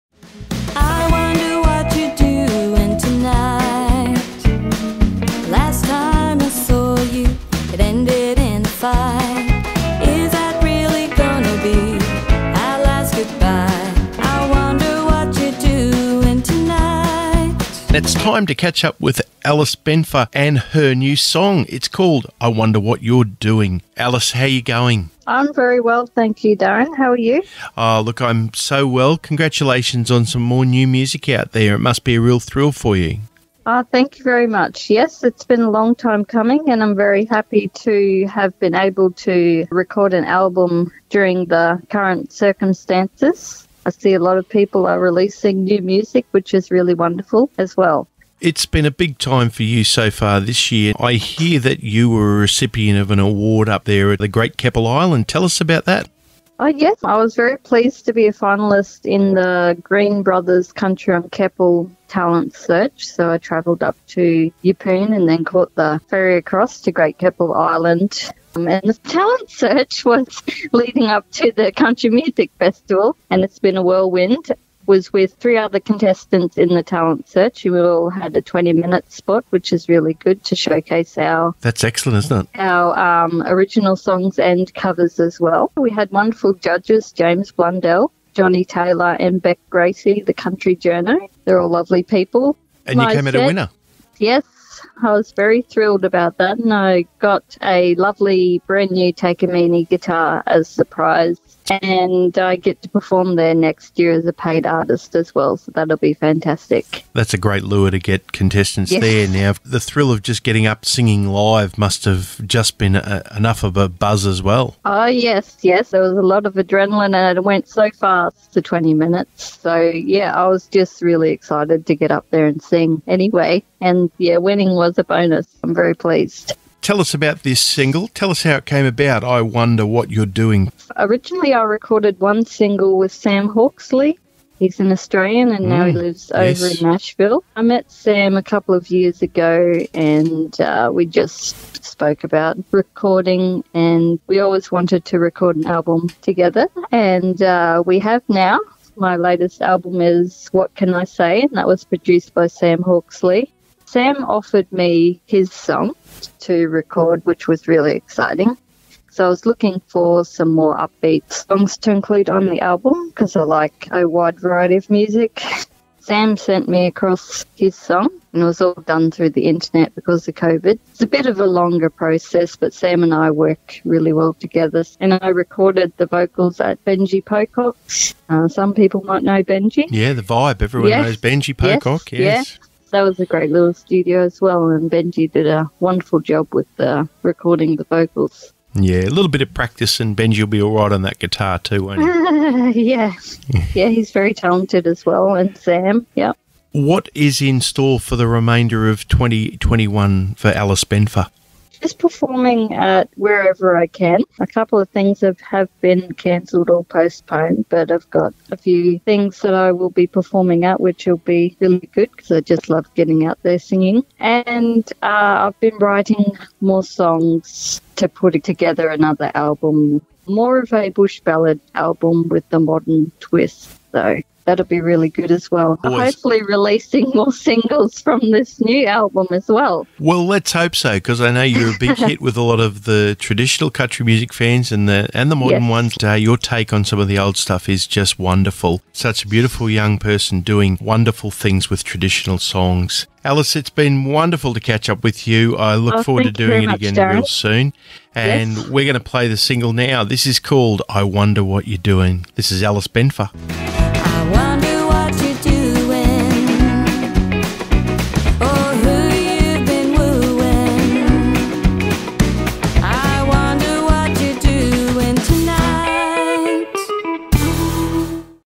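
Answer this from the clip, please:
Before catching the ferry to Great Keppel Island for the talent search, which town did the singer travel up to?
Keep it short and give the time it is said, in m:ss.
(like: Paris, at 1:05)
Yeppoon, at 1:04.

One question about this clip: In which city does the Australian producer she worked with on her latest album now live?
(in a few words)
Nashville.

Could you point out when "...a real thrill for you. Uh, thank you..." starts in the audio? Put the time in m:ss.
0:32.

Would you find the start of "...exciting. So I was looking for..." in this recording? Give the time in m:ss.
2:37.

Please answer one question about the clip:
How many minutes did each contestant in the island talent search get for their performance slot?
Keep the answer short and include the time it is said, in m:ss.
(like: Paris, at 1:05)
20, at 1:18.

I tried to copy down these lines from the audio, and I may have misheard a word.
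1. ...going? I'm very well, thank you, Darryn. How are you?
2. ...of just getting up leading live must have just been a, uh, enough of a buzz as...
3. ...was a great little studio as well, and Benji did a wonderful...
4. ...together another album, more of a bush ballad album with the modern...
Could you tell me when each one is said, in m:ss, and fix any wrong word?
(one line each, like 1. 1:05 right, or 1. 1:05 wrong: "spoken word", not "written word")
1. 0:24 right
2. 1:50 wrong: "singing", not "leading"
3. 3:03 right
4. 3:38 right.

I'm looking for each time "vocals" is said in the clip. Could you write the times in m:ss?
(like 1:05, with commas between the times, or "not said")
2:56, 3:07.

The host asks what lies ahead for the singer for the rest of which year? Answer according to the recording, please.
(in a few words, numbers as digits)
2021.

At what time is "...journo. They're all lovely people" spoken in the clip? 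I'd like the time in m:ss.
1:30.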